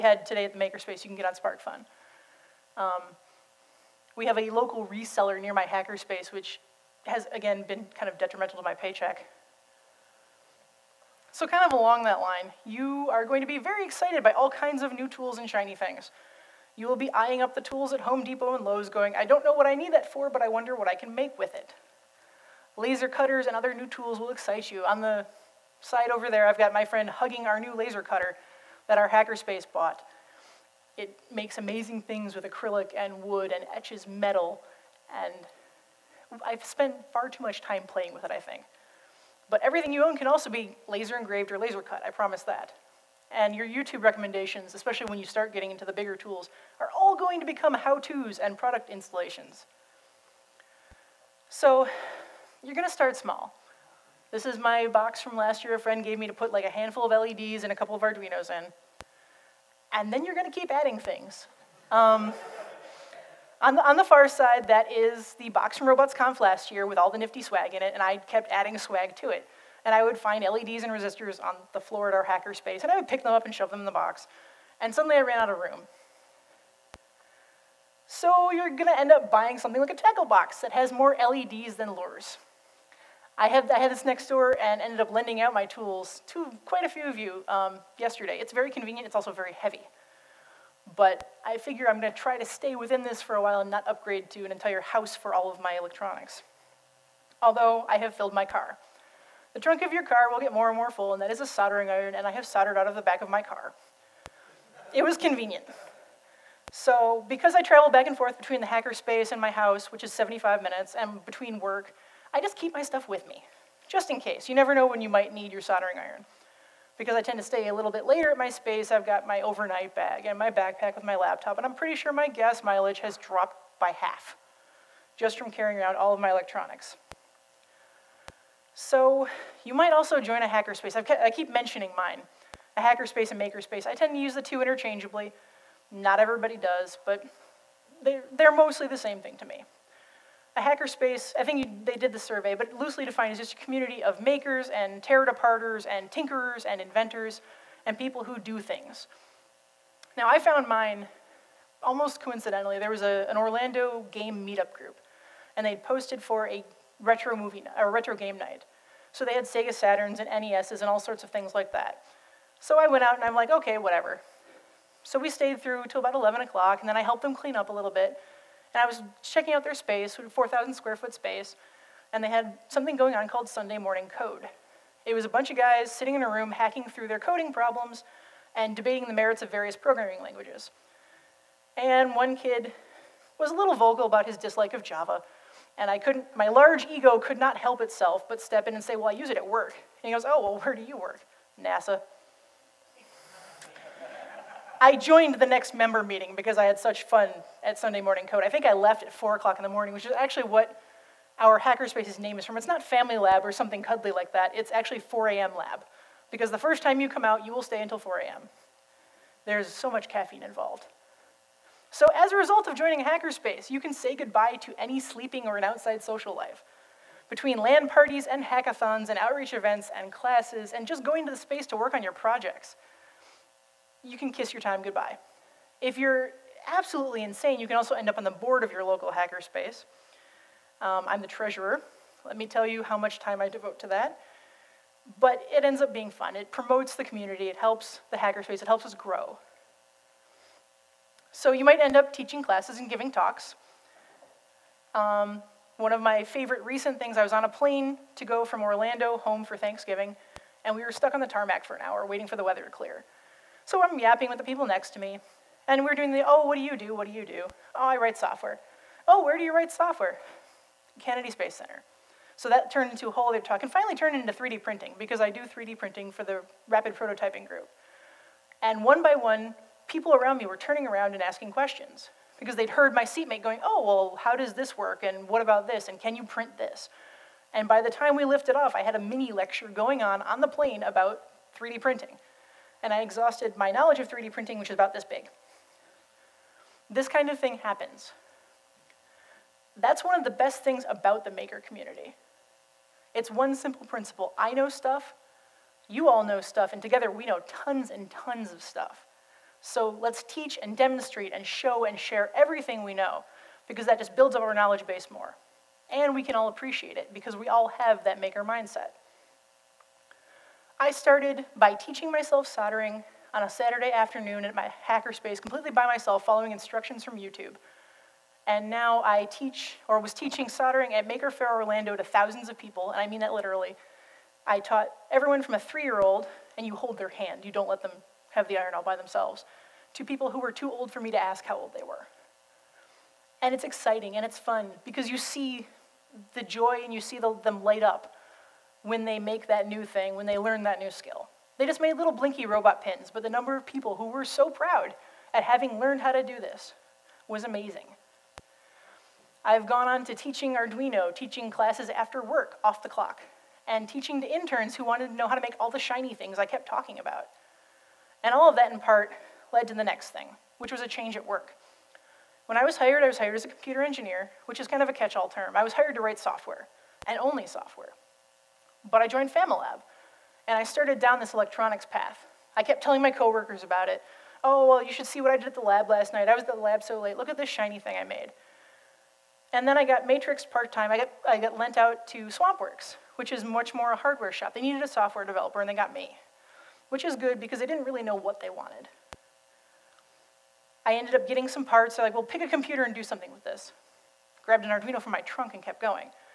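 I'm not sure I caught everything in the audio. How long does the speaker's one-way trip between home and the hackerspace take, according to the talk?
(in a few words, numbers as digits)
75 minutes.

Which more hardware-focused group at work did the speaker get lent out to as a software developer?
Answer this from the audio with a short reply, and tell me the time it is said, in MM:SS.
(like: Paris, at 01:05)
SwampWorks, at 06:22.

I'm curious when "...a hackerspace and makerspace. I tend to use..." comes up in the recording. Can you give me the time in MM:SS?
02:12.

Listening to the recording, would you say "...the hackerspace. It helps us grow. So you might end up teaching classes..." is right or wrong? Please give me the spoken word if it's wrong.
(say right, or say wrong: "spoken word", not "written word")
right.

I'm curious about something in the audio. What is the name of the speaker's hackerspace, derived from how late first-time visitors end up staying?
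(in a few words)
4 a.m. Lab.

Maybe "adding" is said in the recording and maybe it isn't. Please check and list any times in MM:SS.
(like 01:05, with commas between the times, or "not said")
01:00, 01:08.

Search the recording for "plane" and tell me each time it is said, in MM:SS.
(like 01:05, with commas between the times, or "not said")
04:07, 04:40.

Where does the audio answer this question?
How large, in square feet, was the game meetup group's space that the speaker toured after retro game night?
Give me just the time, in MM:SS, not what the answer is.
02:50.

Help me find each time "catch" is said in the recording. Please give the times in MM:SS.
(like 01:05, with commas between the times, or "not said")
06:04.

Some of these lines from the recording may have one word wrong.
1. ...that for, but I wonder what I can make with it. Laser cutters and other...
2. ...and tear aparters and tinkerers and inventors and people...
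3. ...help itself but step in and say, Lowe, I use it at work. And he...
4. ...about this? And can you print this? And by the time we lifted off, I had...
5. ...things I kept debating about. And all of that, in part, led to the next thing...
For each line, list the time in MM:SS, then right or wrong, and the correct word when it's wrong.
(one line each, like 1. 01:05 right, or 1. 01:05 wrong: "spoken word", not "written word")
1. 00:19 right
2. 02:24 right
3. 03:07 wrong: "Well", not "Lowe"
4. 04:35 right
5. 05:56 wrong: "talking", not "debating".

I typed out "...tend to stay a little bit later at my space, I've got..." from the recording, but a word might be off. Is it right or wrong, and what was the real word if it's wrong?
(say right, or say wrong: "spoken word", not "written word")
right.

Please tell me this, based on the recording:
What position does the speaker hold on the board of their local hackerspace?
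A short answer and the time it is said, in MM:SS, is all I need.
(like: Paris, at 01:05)
Treasurer, at 03:51.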